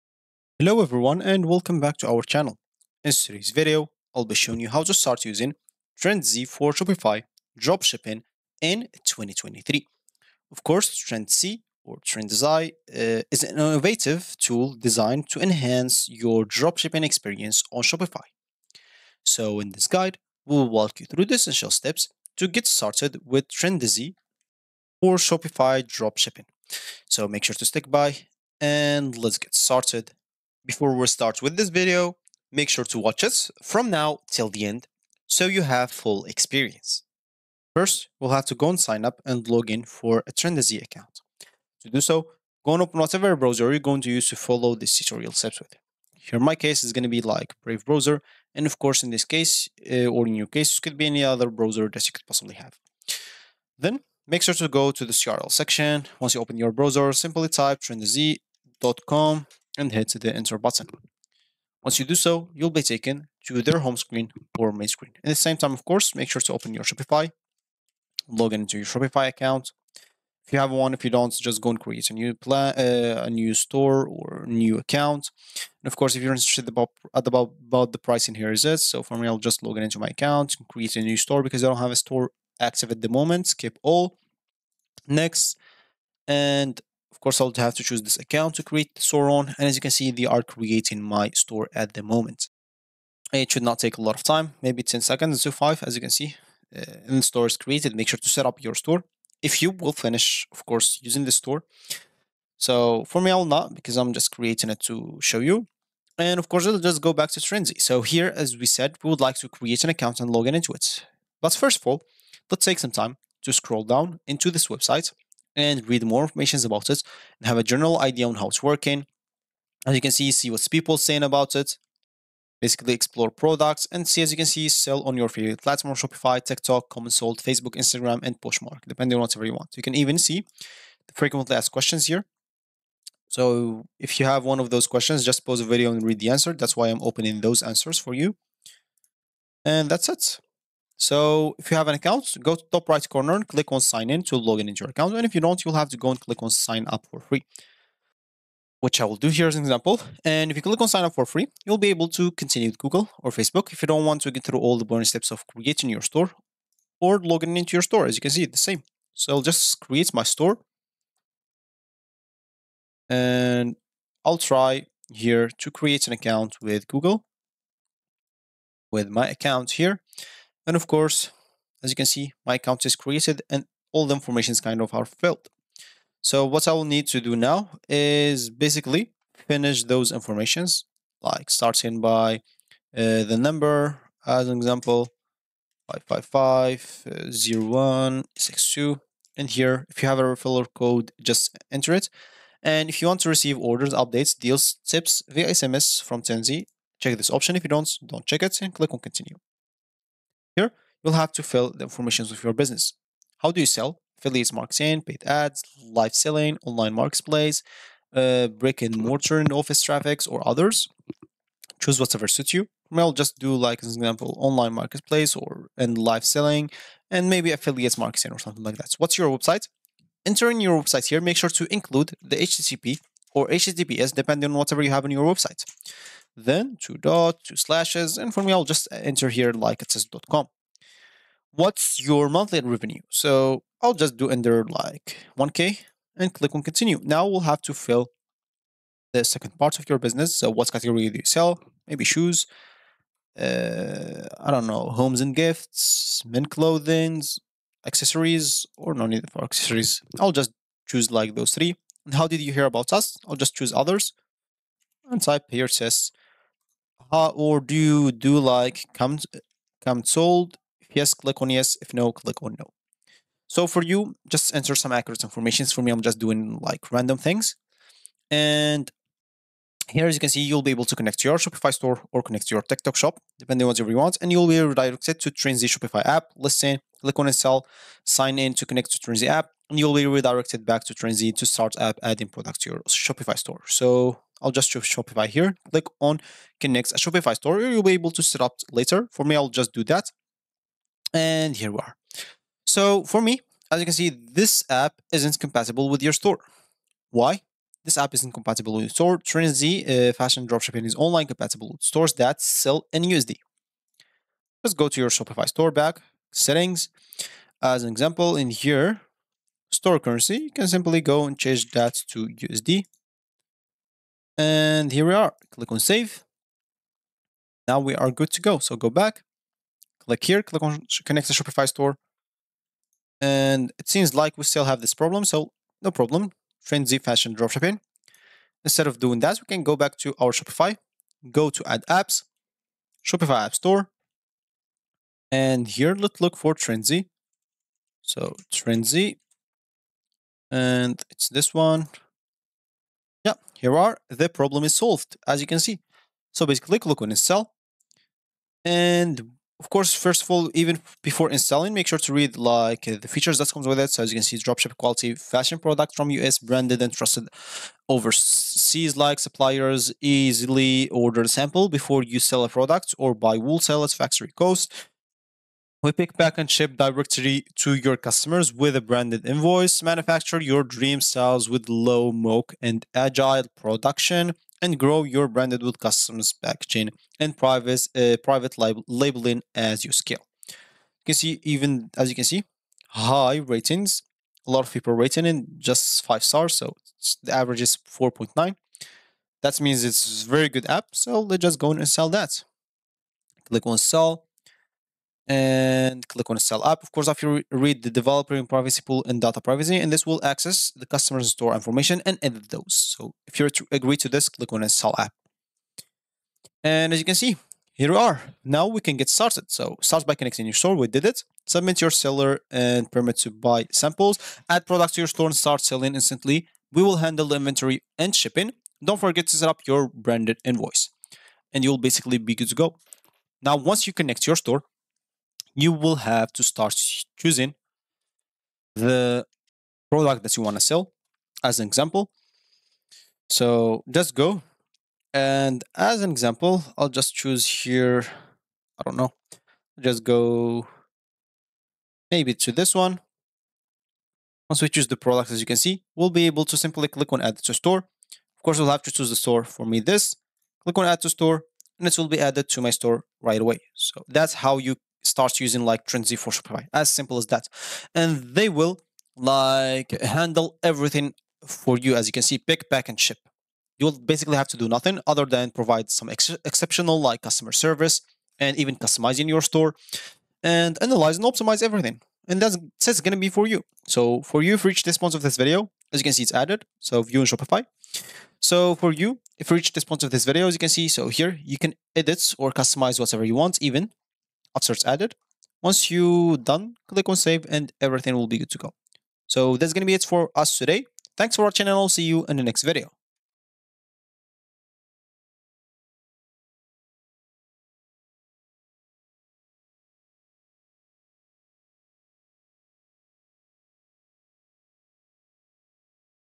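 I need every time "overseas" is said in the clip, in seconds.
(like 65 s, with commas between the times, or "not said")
357 s.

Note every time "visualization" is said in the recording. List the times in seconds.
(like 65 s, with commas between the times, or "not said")
not said.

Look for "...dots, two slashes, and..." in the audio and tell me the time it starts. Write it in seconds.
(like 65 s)
226 s.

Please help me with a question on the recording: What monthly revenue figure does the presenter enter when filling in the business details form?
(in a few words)
1K.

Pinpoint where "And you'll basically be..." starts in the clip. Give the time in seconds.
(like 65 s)
421 s.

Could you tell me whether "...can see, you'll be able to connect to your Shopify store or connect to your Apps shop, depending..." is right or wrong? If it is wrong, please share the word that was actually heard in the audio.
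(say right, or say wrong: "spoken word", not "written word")
wrong: "TikTok", not "Apps".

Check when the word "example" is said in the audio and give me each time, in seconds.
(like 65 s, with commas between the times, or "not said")
149 s, 184 s, 213 s, 307 s, 431 s, 436 s.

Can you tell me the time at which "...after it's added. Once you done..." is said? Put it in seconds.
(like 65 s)
484 s.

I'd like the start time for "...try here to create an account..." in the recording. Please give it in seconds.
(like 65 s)
164 s.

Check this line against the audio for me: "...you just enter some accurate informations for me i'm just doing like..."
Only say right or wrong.
right.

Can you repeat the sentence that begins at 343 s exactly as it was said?
Yeah, here are the problem is solved as you can see.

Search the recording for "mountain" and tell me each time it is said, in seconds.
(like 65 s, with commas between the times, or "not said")
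not said.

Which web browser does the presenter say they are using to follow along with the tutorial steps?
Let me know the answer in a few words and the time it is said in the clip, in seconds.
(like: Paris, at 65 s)
Brave, at 47 s.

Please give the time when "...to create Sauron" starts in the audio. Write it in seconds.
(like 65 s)
88 s.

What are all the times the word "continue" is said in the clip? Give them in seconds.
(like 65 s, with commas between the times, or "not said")
152 s, 198 s, 236 s.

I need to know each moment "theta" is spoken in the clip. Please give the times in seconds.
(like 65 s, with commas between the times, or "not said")
not said.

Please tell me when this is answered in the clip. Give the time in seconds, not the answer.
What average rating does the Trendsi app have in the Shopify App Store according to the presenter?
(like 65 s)
387 s.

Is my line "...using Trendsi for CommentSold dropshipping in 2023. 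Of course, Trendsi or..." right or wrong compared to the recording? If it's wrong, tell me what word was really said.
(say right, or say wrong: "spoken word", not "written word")
wrong: "Shopify", not "CommentSold".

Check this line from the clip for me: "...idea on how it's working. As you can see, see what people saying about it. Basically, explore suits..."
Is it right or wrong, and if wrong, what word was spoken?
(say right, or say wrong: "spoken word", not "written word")
wrong: "products", not "suits".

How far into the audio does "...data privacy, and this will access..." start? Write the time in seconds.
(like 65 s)
399 s.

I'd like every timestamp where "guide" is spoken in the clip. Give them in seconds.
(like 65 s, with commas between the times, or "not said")
19 s.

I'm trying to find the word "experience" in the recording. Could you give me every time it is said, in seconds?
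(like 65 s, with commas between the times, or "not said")
17 s, 36 s.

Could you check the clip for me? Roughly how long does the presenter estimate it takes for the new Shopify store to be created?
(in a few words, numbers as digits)
10 seconds.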